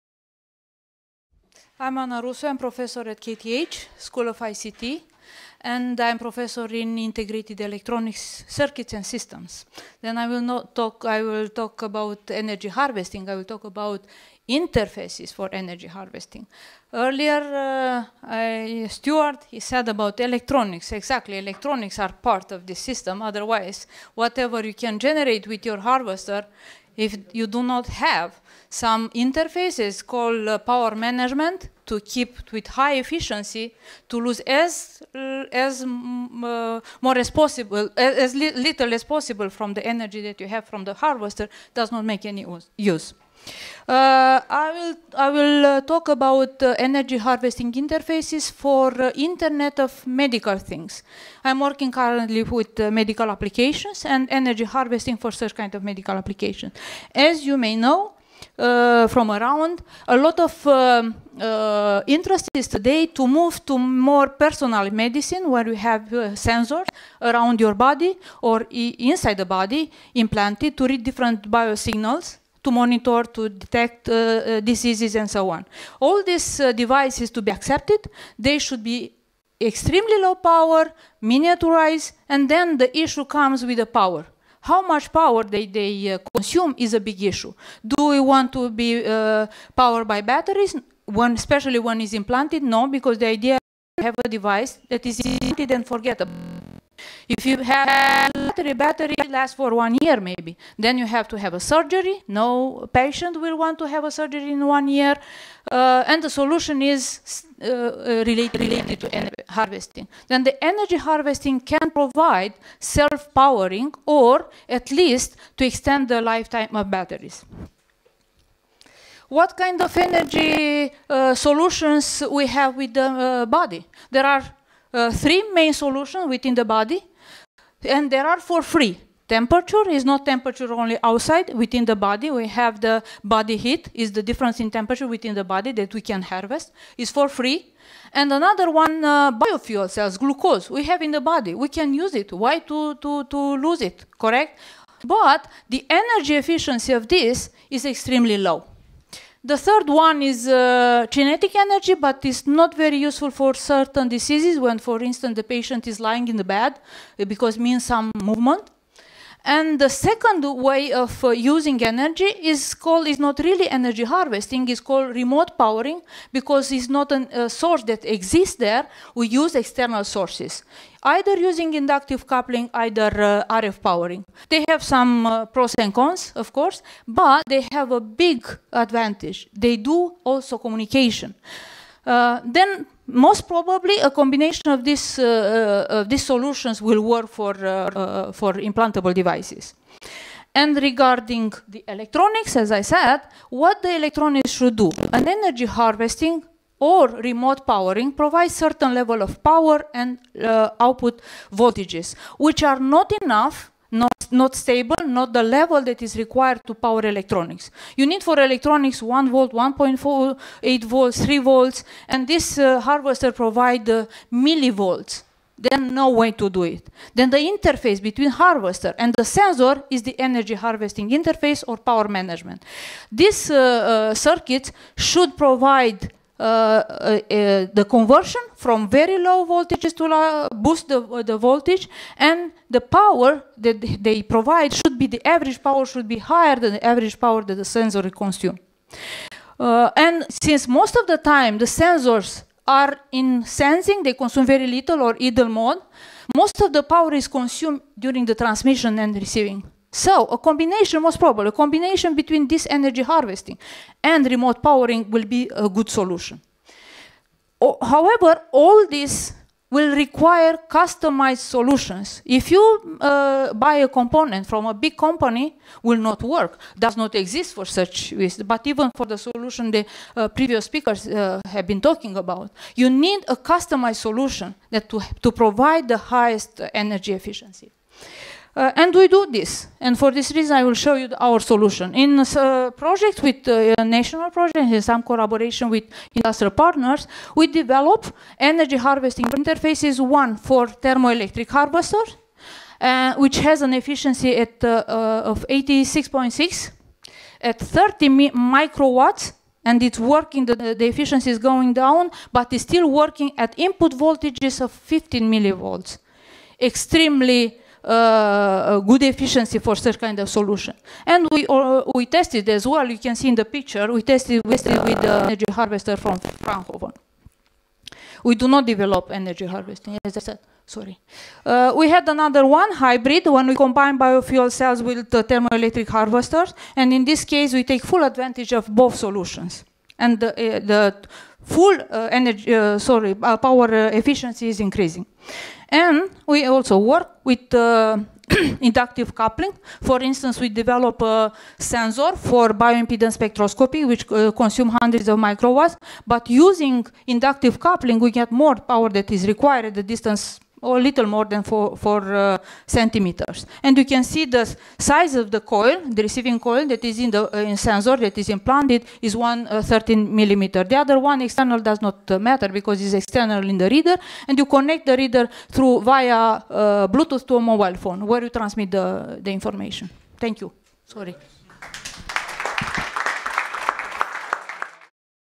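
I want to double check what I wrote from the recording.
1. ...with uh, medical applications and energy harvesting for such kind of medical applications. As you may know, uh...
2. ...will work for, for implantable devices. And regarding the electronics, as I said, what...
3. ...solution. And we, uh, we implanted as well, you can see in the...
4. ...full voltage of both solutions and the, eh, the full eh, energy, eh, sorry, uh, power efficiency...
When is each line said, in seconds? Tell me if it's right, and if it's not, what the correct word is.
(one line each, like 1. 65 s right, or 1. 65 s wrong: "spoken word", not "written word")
1. 52 s right
2. 186 s right
3. 310 s wrong: "tested", not "implanted"
4. 327 s wrong: "advantage", not "voltage".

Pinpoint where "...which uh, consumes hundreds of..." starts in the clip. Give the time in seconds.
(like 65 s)
343 s.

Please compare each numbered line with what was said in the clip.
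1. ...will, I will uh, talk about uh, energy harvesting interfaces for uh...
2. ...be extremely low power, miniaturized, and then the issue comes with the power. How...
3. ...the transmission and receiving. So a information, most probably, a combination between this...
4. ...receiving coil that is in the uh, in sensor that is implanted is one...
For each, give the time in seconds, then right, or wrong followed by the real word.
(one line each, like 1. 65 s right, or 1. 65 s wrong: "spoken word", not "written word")
1. 44 s right
2. 78 s right
3. 248 s wrong: "combination", not "information"
4. 356 s right.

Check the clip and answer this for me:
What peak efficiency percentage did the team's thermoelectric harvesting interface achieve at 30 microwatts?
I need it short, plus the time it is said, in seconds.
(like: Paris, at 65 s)
86.6, at 295 s.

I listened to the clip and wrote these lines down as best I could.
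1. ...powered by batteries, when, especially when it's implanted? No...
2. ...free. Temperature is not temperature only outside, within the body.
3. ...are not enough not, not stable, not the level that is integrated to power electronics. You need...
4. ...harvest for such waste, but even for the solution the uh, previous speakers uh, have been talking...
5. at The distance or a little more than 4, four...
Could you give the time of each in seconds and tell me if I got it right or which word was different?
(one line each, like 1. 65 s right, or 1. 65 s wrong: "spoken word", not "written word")
1. 89 s right
2. 128 s right
3. 202 s wrong: "required", not "integrated"
4. 267 s wrong: "exist", not "harvest"
5. 349 s right.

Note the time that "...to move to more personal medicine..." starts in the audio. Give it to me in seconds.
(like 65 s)
63 s.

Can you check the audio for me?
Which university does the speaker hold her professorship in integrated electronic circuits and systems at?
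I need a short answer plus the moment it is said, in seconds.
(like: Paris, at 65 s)
KTH, at 3 s.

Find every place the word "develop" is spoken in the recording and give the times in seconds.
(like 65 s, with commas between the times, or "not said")
287 s, 318 s, 340 s.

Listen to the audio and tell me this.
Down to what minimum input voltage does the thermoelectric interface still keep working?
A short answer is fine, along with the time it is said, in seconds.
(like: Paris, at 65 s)
15 millivolts, at 304 s.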